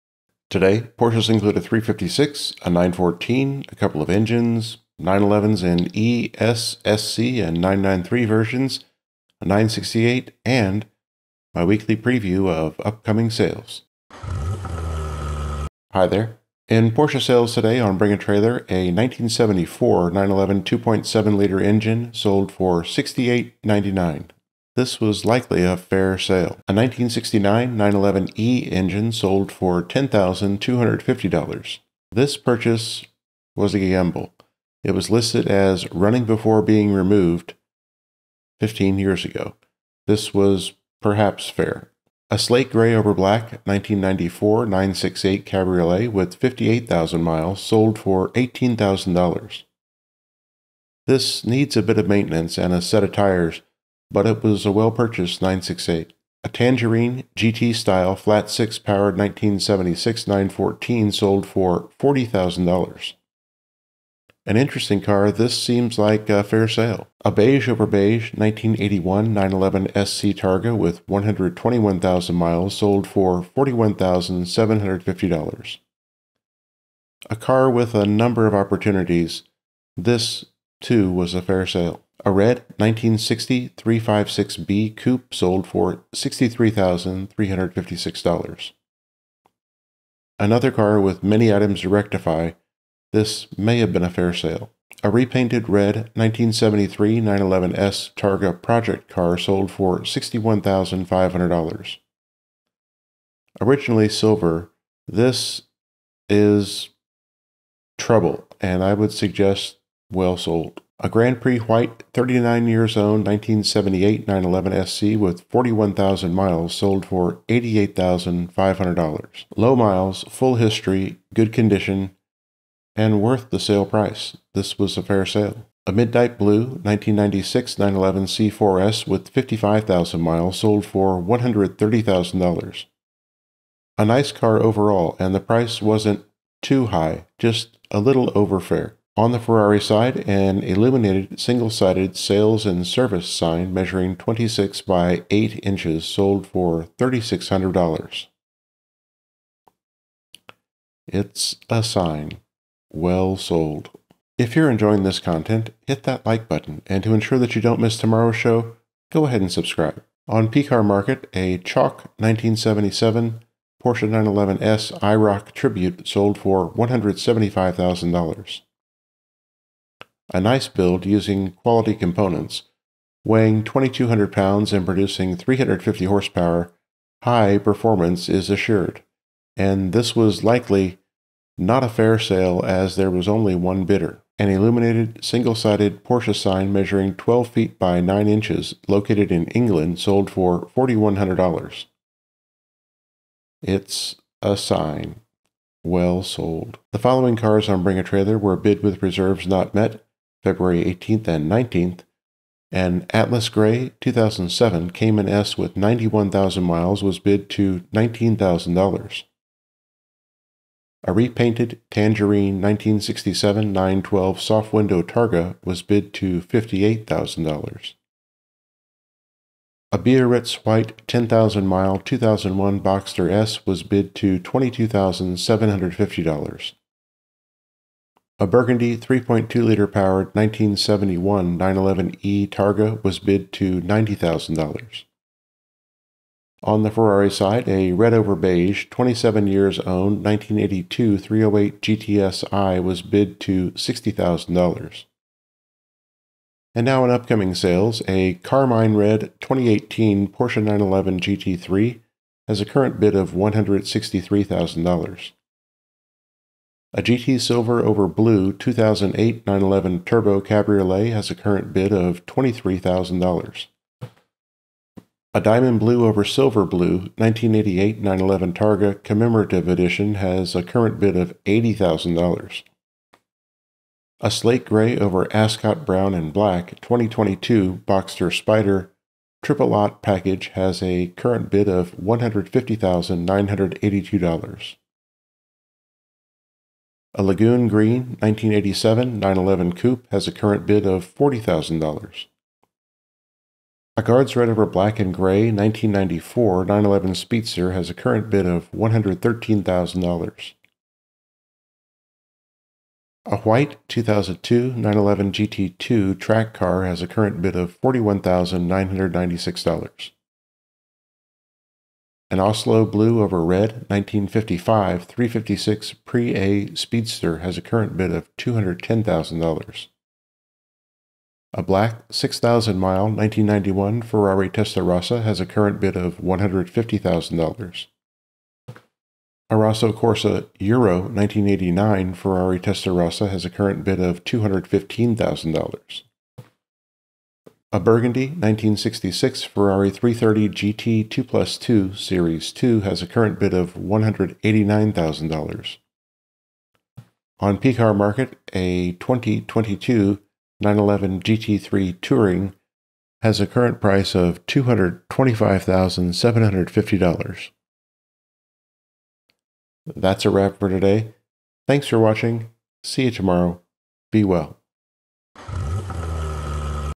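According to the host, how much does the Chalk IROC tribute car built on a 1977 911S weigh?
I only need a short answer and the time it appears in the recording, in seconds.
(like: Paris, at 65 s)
2,200 pounds, at 173 s.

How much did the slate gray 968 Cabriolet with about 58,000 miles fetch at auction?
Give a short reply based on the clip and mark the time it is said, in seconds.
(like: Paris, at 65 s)
$18,000, at 48 s.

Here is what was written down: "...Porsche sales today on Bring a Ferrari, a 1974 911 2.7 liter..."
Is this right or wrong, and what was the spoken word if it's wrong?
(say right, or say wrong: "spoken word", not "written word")
wrong: "Trailer", not "Ferrari".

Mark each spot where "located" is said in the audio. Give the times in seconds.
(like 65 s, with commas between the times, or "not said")
188 s.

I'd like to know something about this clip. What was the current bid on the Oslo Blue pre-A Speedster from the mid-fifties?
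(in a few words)
$210,000.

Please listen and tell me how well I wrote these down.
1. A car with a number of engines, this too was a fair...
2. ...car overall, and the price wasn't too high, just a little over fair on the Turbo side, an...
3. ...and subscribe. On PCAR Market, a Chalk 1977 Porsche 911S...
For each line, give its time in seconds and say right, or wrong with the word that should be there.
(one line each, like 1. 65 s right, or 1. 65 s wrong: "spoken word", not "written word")
1. 77 s wrong: "opportunities", not "engines"
2. 134 s wrong: "Ferrari", not "Turbo"
3. 159 s right.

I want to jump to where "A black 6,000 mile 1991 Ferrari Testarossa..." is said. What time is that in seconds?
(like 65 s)
321 s.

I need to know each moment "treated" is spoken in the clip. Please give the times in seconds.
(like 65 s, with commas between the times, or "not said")
not said.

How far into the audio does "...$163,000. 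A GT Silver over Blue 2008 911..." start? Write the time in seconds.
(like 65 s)
253 s.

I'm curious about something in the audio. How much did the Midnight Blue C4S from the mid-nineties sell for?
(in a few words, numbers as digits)
$130,000.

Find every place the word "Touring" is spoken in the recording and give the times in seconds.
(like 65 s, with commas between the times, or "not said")
352 s.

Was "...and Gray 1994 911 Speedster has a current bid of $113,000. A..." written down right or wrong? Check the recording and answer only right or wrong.
right.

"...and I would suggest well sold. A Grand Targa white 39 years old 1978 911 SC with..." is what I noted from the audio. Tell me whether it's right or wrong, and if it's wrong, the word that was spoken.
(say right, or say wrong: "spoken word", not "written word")
wrong: "Prix", not "Targa".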